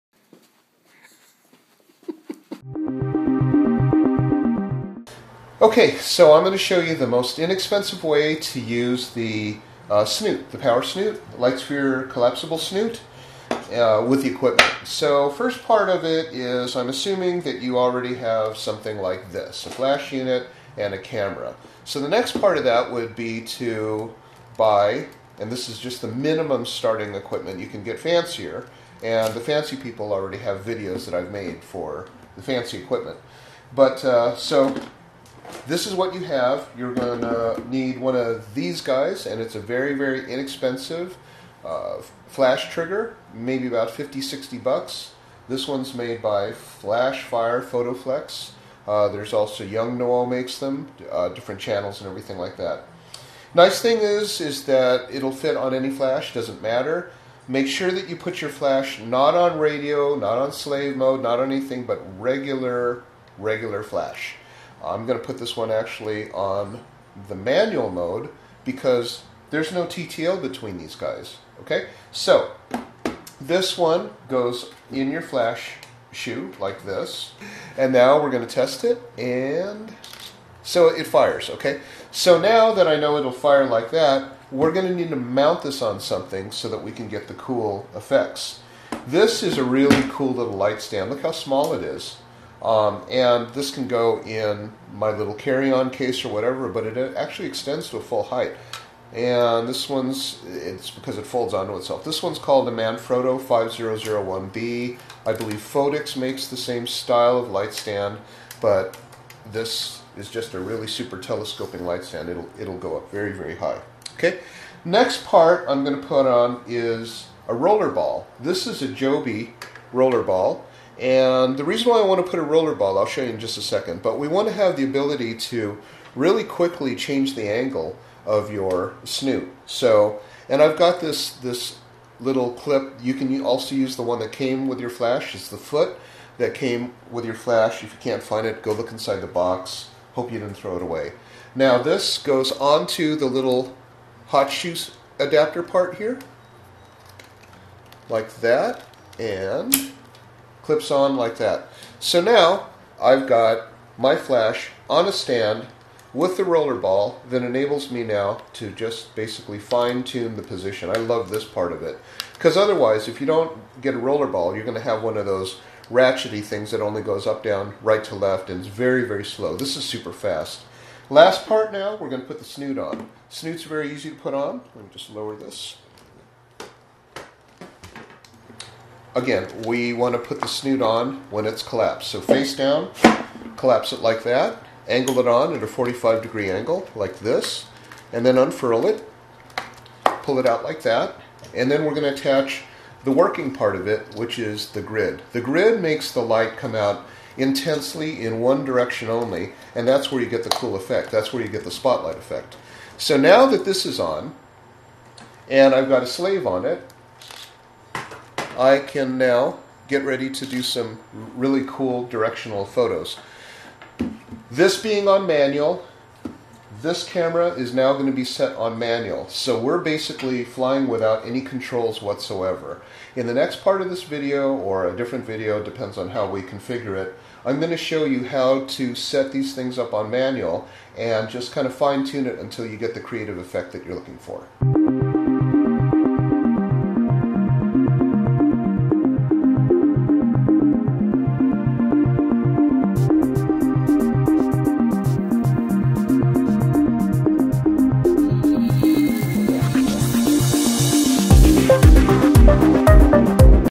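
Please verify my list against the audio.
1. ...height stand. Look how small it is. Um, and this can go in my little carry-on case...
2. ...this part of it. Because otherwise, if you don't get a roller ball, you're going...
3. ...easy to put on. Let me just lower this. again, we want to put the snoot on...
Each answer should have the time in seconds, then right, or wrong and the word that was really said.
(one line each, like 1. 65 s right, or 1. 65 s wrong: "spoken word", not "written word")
1. 90 s wrong: "light", not "height"
2. 161 s right
3. 173 s right.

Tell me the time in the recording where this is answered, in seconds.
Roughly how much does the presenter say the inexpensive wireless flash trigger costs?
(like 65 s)
43 s.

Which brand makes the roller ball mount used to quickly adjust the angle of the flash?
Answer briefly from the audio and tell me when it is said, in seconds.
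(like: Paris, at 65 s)
Joby, at 118 s.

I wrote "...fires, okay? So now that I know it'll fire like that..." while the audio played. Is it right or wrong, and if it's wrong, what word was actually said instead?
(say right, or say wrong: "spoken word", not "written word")
right.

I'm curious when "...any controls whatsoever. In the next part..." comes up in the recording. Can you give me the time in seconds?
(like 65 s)
221 s.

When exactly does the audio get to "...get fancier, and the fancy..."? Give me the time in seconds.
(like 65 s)
27 s.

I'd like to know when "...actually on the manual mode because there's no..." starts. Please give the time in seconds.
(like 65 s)
65 s.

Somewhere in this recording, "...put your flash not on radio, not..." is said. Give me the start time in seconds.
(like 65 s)
58 s.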